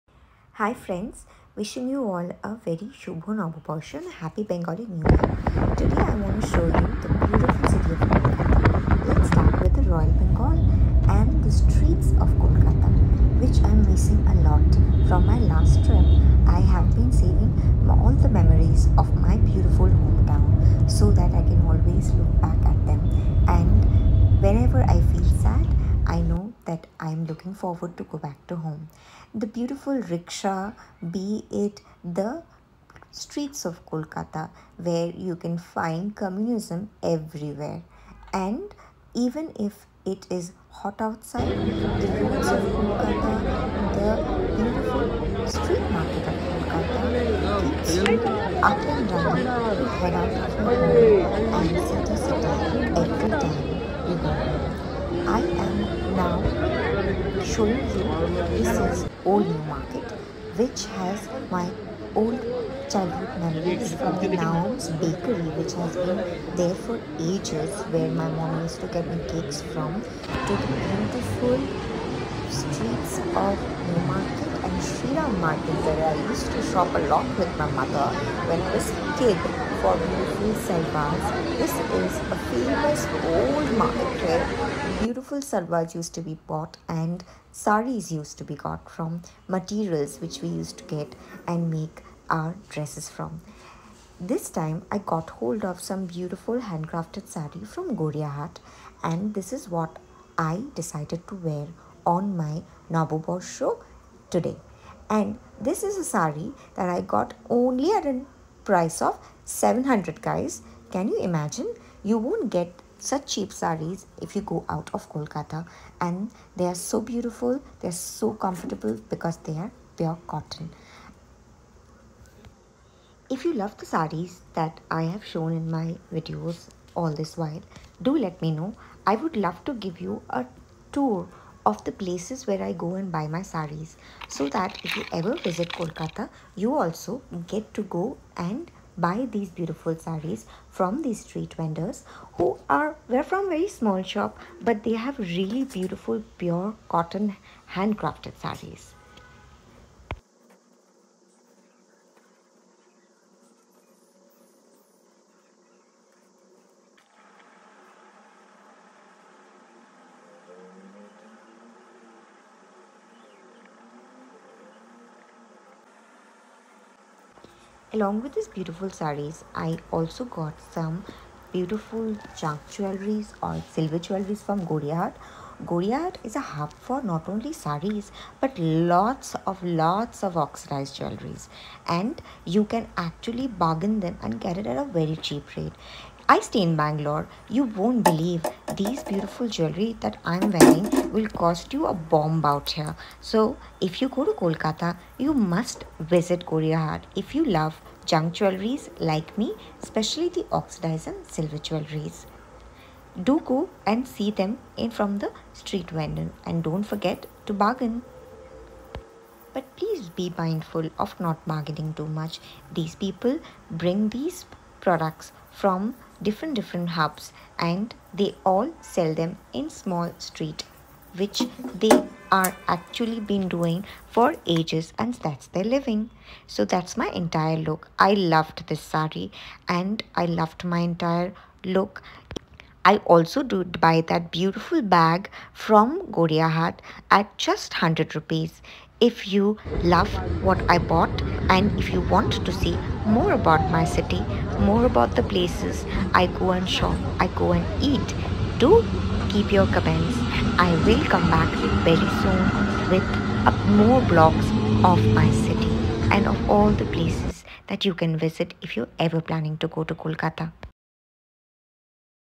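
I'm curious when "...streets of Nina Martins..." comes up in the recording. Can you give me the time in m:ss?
1:12.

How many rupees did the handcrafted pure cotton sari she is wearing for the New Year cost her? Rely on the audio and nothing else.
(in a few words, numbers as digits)
700.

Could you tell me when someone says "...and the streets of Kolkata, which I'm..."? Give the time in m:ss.
0:11.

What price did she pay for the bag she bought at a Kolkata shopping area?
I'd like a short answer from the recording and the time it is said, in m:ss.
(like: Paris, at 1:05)
100 rupees, at 3:57.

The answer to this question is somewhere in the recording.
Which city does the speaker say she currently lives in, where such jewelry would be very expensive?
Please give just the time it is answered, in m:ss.
3:06.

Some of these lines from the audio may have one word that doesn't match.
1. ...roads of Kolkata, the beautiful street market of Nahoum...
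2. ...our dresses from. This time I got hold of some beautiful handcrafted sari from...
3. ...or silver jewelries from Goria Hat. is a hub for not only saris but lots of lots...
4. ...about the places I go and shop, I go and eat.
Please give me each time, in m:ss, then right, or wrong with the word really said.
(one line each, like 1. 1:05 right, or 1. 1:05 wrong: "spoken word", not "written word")
1. 0:41 wrong: "Kolkata", not "Nahoum"
2. 1:32 right
3. 2:53 right
4. 4:04 right.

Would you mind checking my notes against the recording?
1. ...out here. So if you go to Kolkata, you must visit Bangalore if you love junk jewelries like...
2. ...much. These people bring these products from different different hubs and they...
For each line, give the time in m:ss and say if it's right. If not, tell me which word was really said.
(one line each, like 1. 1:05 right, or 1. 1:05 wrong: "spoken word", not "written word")
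1. 3:12 wrong: "Gariahat", not "Bangalore"
2. 3:32 right.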